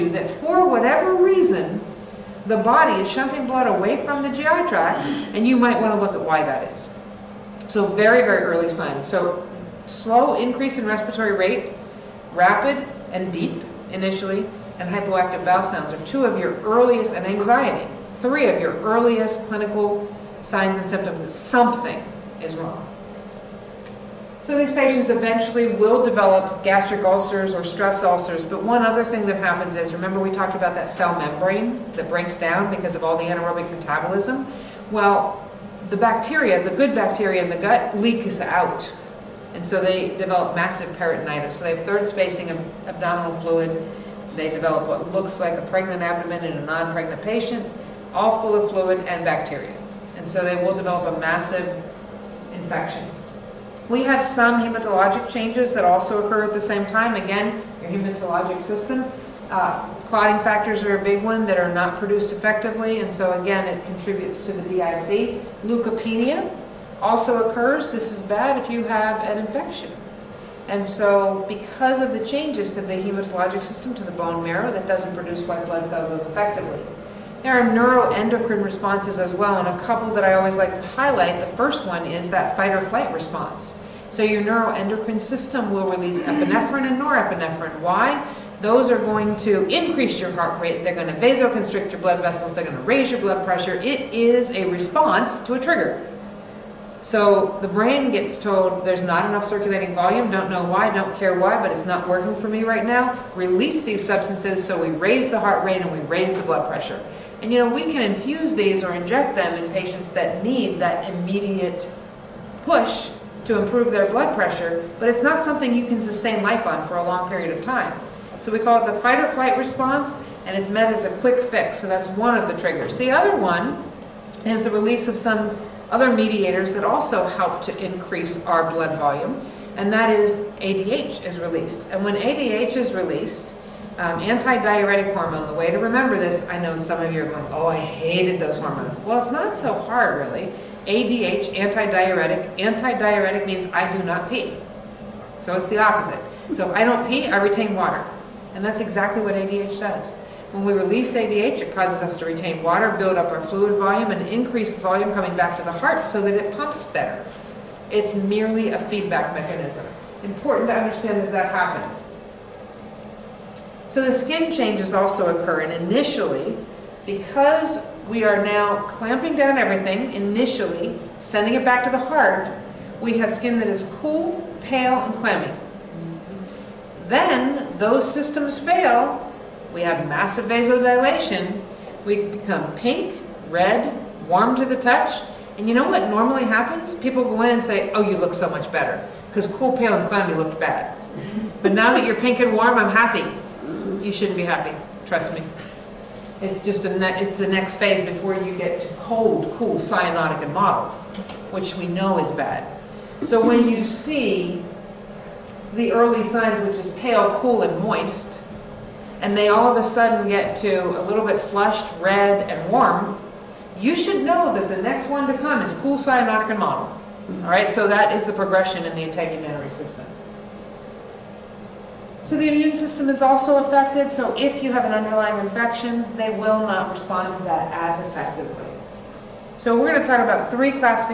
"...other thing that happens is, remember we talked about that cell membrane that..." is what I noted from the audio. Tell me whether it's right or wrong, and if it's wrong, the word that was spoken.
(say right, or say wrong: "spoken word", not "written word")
right.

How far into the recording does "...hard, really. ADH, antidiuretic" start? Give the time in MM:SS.
02:19.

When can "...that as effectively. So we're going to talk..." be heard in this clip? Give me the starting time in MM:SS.
03:47.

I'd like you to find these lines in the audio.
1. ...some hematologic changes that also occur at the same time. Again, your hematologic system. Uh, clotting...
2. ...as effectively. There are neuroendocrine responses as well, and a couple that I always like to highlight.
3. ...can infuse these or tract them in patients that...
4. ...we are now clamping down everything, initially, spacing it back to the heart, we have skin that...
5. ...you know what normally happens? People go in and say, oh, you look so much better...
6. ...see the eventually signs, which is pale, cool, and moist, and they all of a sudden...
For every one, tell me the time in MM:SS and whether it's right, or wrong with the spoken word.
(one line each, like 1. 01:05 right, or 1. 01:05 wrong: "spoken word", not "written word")
1. 00:54 right
2. 01:16 right
3. 01:47 wrong: "inject", not "tract"
4. 02:48 wrong: "sending", not "spacing"
5. 03:05 right
6. 03:23 wrong: "early", not "eventually".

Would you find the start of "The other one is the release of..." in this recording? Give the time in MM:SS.
02:02.